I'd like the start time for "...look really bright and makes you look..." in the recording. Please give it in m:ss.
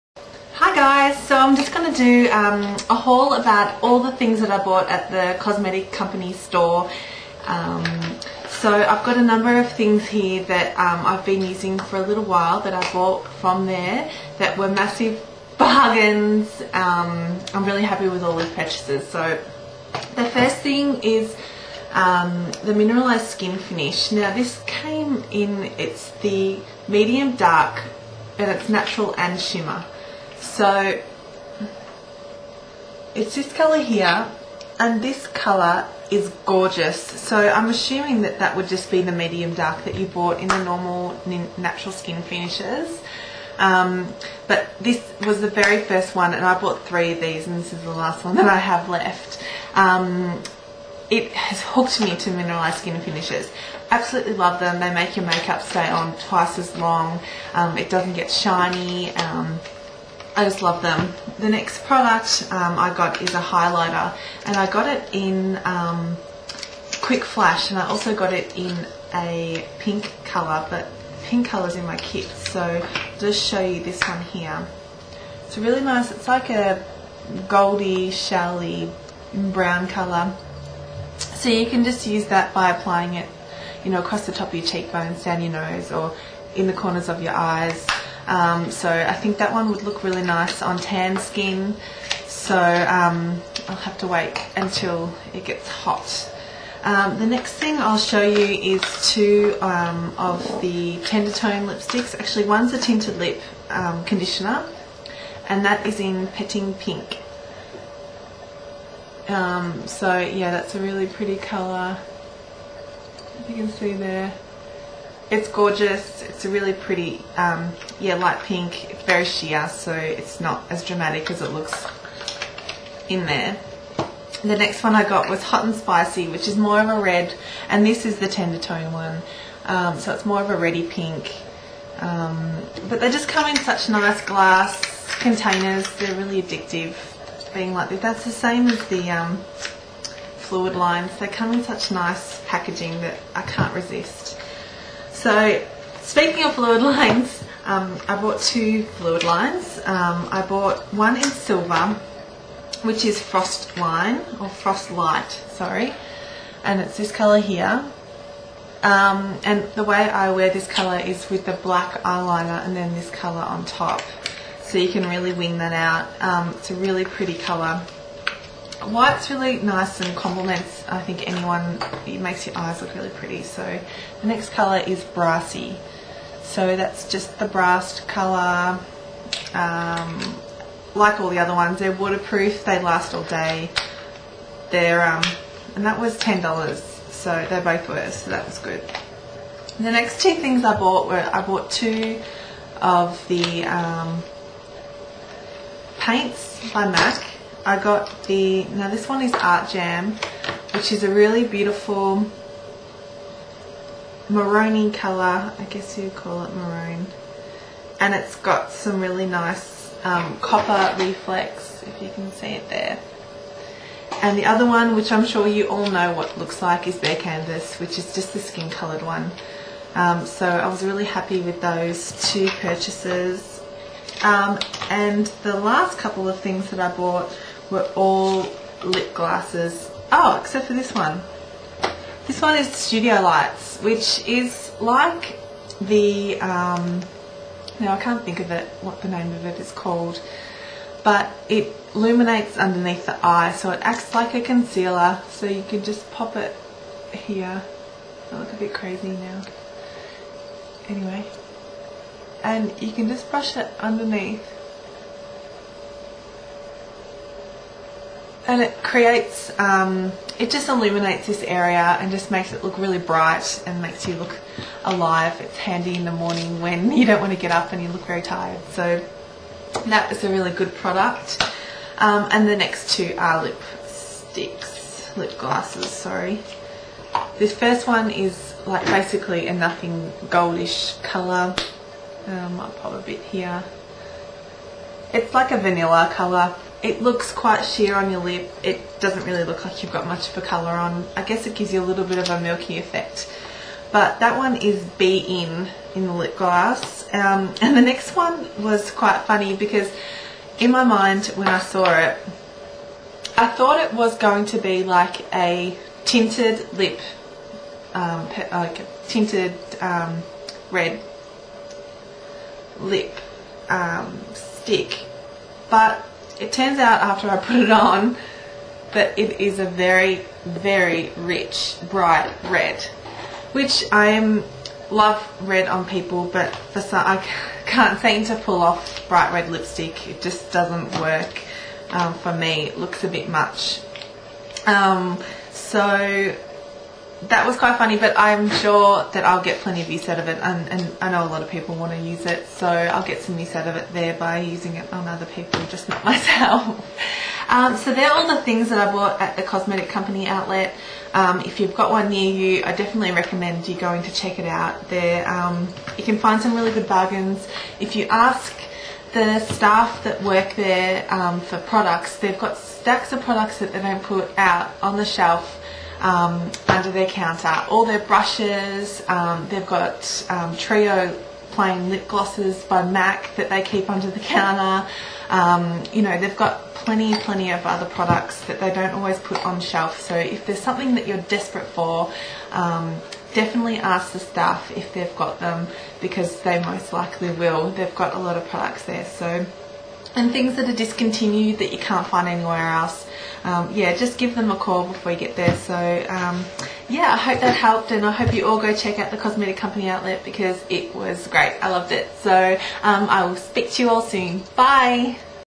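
4:22.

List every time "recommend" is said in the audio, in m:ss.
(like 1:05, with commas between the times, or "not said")
5:53.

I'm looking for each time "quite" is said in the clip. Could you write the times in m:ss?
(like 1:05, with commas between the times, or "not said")
4:47, 4:58, 5:37.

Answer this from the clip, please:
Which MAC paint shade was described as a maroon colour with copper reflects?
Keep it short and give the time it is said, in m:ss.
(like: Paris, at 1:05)
Art Jam, at 3:19.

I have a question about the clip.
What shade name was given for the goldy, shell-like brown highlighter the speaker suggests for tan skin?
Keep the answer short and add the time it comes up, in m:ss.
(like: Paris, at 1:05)
Quick Flash, at 1:06.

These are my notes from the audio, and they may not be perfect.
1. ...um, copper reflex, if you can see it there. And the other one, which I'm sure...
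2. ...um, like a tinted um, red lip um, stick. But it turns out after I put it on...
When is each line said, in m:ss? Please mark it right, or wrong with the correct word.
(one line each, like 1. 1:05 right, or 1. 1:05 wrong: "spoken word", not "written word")
1. 3:30 right
2. 5:07 right.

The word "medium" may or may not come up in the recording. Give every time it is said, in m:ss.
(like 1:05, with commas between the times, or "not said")
0:26, 0:39.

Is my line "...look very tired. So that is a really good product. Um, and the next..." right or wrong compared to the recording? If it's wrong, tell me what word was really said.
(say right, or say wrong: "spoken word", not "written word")
right.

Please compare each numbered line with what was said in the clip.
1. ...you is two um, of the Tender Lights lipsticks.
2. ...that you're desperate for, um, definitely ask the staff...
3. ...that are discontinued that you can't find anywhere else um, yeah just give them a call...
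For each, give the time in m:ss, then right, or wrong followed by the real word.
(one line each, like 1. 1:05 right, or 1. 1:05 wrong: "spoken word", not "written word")
1. 1:38 wrong: "Tone", not "Lights"
2. 6:20 right
3. 6:30 right.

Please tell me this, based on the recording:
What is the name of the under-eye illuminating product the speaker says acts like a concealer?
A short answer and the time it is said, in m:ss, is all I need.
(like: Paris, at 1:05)
Studio Lights, at 3:52.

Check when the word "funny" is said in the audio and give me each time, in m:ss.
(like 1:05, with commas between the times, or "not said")
4:59, 5:37.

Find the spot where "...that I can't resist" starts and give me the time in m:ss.
2:22.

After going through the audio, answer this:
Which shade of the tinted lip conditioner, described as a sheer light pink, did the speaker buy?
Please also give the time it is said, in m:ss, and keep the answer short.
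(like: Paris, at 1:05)
Petting Pink, at 1:46.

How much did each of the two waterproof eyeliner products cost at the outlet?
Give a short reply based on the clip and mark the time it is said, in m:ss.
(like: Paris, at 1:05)
$10, at 3:06.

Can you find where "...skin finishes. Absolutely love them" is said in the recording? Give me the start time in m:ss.
0:52.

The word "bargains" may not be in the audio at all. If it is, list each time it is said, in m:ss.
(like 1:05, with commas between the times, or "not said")
0:15, 5:56.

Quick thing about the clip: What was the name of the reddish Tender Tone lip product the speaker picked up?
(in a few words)
Hot and Spicy.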